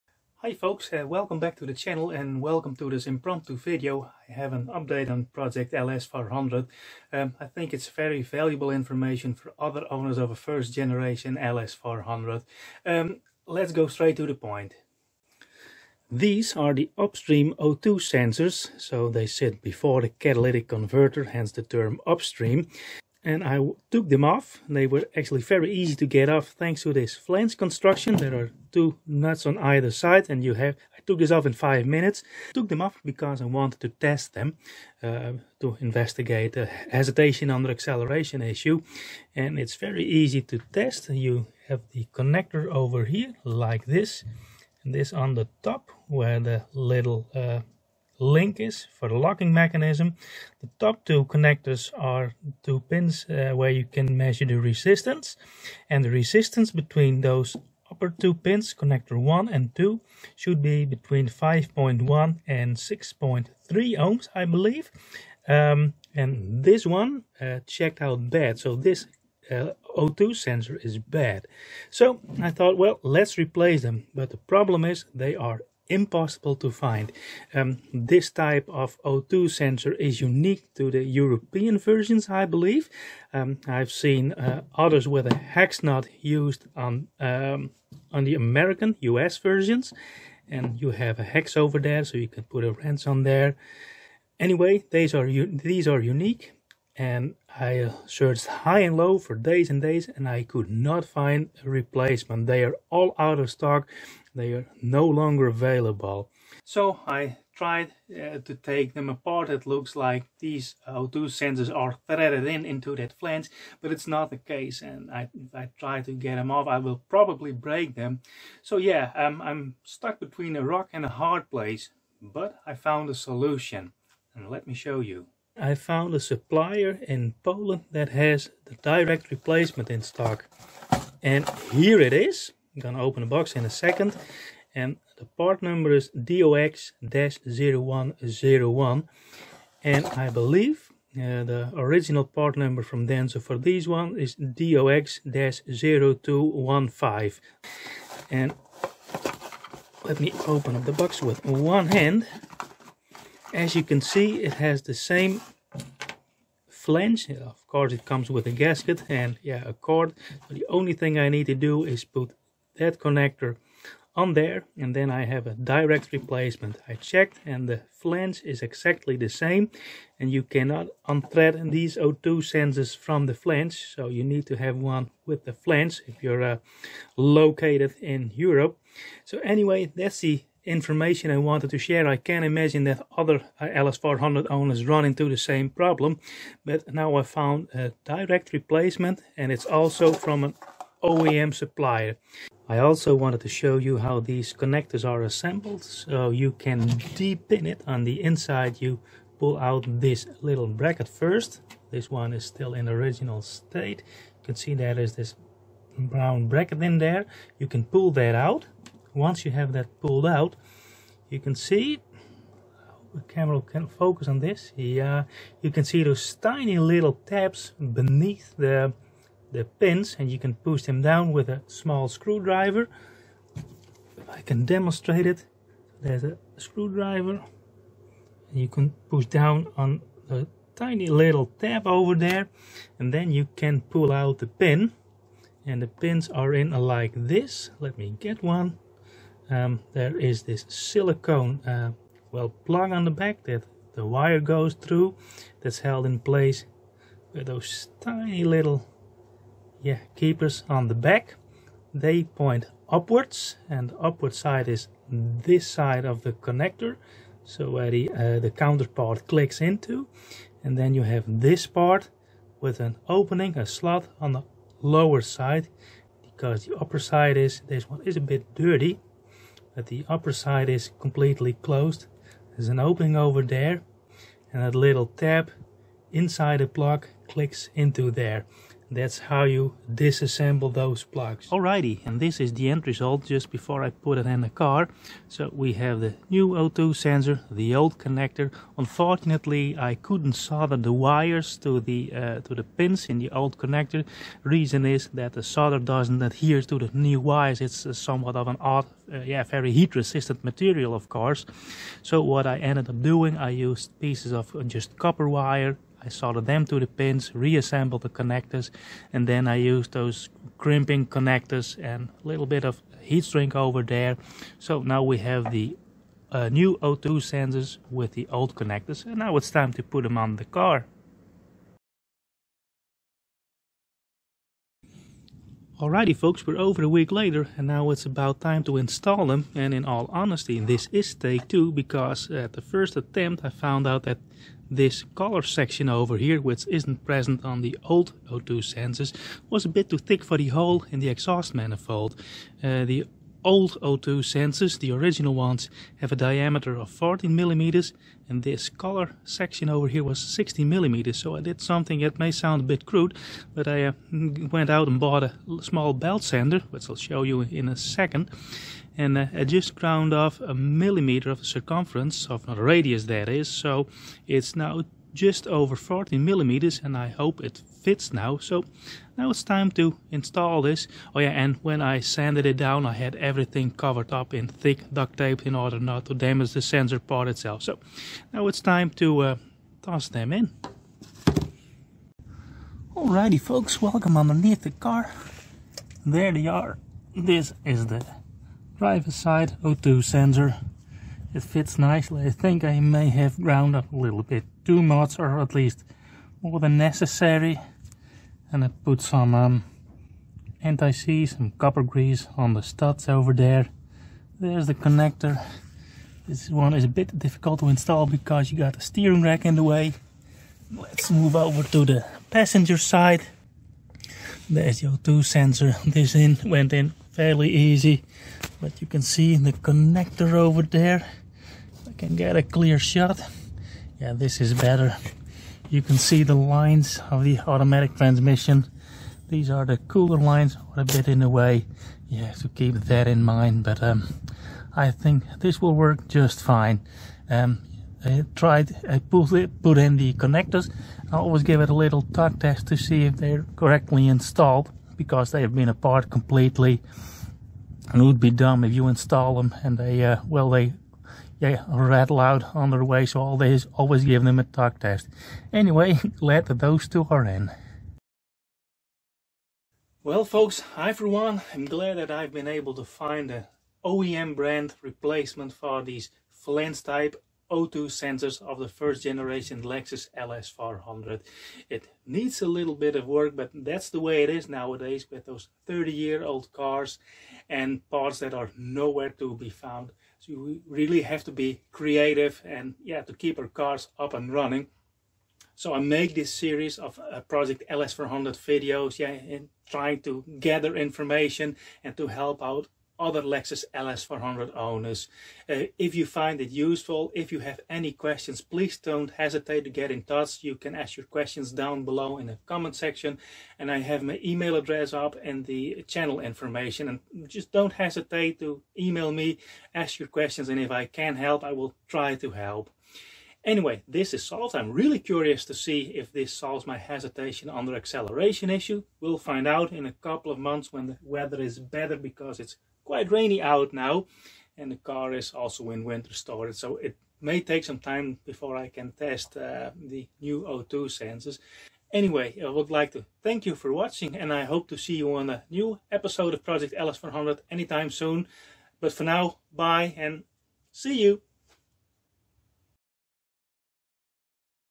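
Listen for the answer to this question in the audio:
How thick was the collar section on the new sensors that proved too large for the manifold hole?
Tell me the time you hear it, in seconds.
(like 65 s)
350 s.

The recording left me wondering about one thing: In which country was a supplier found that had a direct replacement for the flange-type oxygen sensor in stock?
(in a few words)
Poland.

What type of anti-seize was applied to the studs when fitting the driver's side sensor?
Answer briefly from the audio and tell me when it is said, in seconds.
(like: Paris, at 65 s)
Copper grease, at 401 s.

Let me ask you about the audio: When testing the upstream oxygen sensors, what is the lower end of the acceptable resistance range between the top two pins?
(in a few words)
5.1 ohms.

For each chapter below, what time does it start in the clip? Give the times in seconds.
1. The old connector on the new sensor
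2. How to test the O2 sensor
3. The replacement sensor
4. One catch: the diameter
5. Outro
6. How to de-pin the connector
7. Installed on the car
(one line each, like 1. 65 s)
1. 280 s
2. 40 s
3. 126 s
4. 323 s
5. 461 s
6. 192 s
7. 382 s.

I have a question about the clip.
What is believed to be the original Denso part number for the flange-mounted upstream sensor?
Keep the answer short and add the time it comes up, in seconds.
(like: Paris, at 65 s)
DOX-0215, at 144 s.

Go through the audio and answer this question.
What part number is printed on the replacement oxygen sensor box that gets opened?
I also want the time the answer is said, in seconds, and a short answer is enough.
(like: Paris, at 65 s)
DOX-0101, at 136 s.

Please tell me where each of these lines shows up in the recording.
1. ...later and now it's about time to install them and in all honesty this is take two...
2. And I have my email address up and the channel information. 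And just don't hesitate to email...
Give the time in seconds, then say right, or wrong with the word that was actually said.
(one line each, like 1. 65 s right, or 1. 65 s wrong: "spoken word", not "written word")
1. 327 s right
2. 503 s right.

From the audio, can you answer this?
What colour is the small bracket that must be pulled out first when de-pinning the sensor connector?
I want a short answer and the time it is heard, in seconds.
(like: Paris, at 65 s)
Brown, at 205 s.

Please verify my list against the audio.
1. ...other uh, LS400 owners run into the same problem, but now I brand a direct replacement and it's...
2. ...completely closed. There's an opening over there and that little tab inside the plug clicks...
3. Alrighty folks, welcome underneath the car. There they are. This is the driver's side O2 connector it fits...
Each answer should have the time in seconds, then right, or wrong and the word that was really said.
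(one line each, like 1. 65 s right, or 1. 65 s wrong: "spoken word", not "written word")
1. 183 s wrong: "found", not "brand"
2. 270 s right
3. 382 s wrong: "sensor", not "connector".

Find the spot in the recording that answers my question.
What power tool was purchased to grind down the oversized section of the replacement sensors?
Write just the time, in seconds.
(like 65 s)
355 s.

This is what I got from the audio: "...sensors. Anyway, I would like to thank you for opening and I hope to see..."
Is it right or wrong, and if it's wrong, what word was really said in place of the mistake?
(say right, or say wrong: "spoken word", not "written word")
wrong: "watching", not "opening".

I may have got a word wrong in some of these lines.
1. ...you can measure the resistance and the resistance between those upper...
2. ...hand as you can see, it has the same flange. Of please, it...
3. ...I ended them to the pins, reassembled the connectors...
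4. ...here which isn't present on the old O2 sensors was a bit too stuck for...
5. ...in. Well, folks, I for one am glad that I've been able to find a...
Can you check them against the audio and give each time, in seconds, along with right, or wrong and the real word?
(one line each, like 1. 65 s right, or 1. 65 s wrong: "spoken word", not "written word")
1. 53 s right
2. 151 s wrong: "course", not "please"
3. 306 s wrong: "soldered", not "ended"
4. 336 s wrong: "thick", not "stuck"
5. 457 s right.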